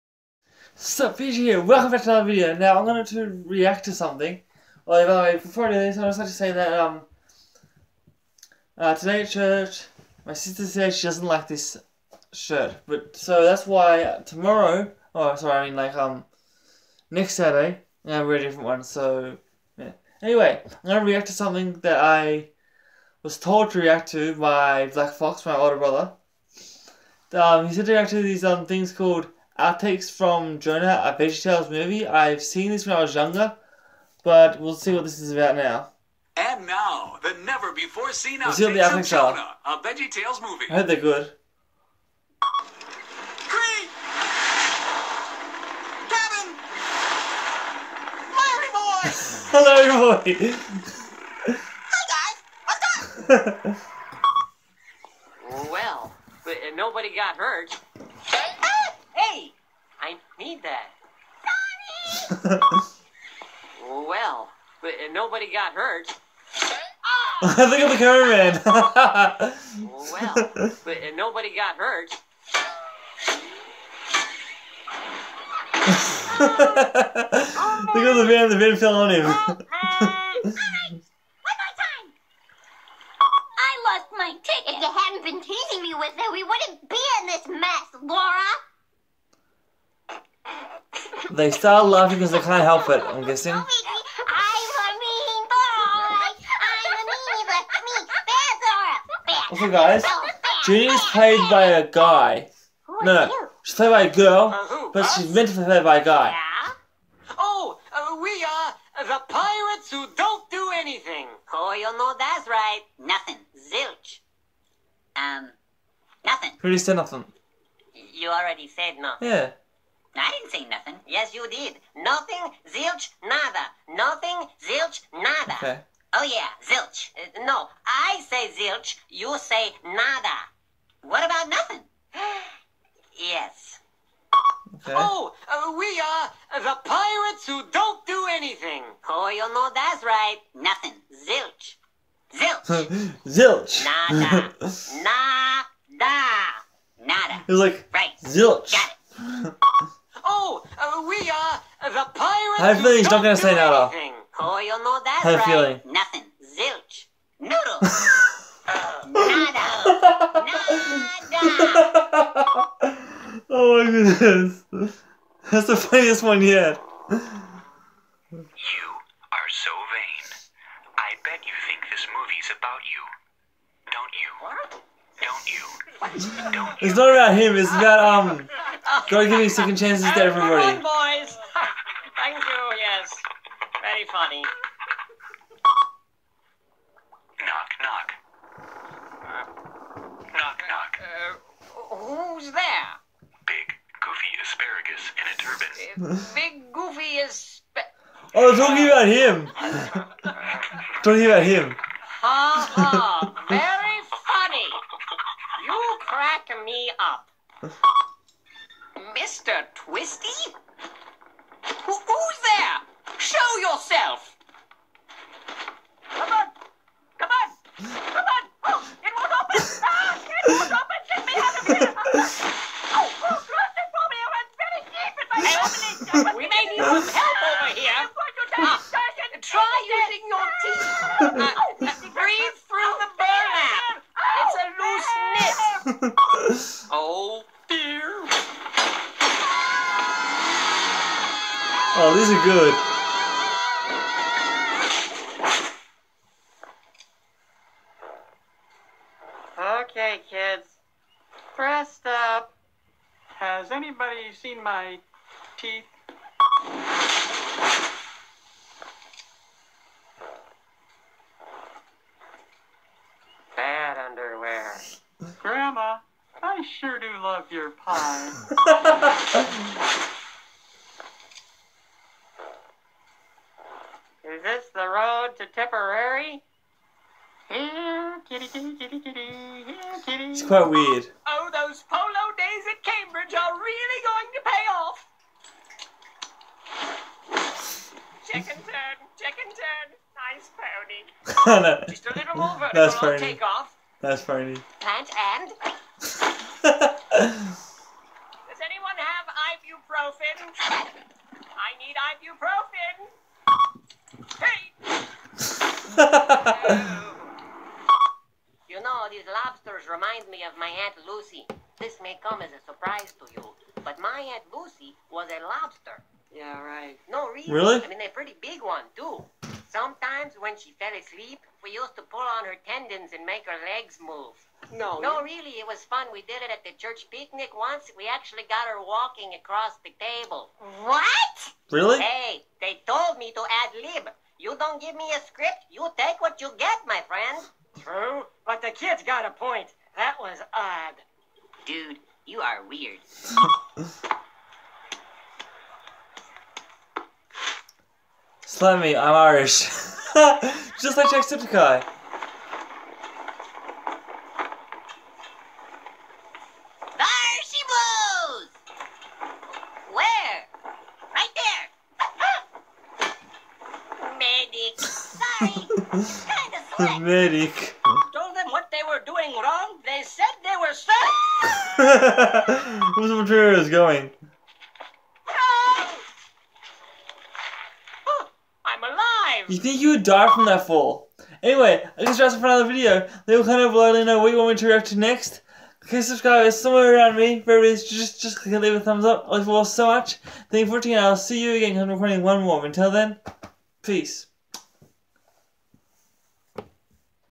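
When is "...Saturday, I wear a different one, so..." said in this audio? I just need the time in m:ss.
0:17.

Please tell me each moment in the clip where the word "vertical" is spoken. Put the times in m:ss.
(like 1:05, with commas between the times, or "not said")
4:52.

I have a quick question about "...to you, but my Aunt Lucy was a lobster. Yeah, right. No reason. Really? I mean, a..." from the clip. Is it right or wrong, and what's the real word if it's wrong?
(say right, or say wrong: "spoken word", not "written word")
right.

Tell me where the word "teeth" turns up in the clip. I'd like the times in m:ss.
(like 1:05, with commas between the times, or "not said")
3:50, 4:15.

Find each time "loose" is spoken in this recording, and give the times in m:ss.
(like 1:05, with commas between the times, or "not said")
3:56.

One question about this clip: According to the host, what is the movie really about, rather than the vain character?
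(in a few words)
God giving second chances.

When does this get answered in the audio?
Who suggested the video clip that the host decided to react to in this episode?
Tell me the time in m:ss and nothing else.
0:24.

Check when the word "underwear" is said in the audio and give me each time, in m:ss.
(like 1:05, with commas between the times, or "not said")
4:24.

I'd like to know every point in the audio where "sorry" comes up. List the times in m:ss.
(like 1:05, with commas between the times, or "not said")
0:15, 6:10.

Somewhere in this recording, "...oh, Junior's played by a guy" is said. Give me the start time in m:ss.
1:40.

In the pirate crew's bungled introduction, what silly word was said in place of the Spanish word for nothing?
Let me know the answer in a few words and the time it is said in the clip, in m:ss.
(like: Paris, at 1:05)
Noodle, at 2:37.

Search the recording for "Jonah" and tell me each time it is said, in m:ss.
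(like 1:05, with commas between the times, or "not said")
0:30, 0:39.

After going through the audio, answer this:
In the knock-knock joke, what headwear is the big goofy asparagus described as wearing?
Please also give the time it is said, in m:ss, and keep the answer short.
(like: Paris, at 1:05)
A turban, at 3:16.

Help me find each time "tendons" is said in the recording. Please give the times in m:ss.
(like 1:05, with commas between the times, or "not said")
5:22.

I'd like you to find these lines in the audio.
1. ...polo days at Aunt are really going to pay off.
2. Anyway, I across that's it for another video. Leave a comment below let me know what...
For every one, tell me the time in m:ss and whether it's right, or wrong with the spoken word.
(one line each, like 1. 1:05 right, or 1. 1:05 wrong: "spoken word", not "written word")
1. 4:41 wrong: "Cambridge", not "Aunt"
2. 6:21 wrong: "guess", not "across".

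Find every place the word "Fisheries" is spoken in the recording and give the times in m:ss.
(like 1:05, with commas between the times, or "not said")
not said.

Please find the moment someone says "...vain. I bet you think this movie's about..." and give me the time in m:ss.
2:49.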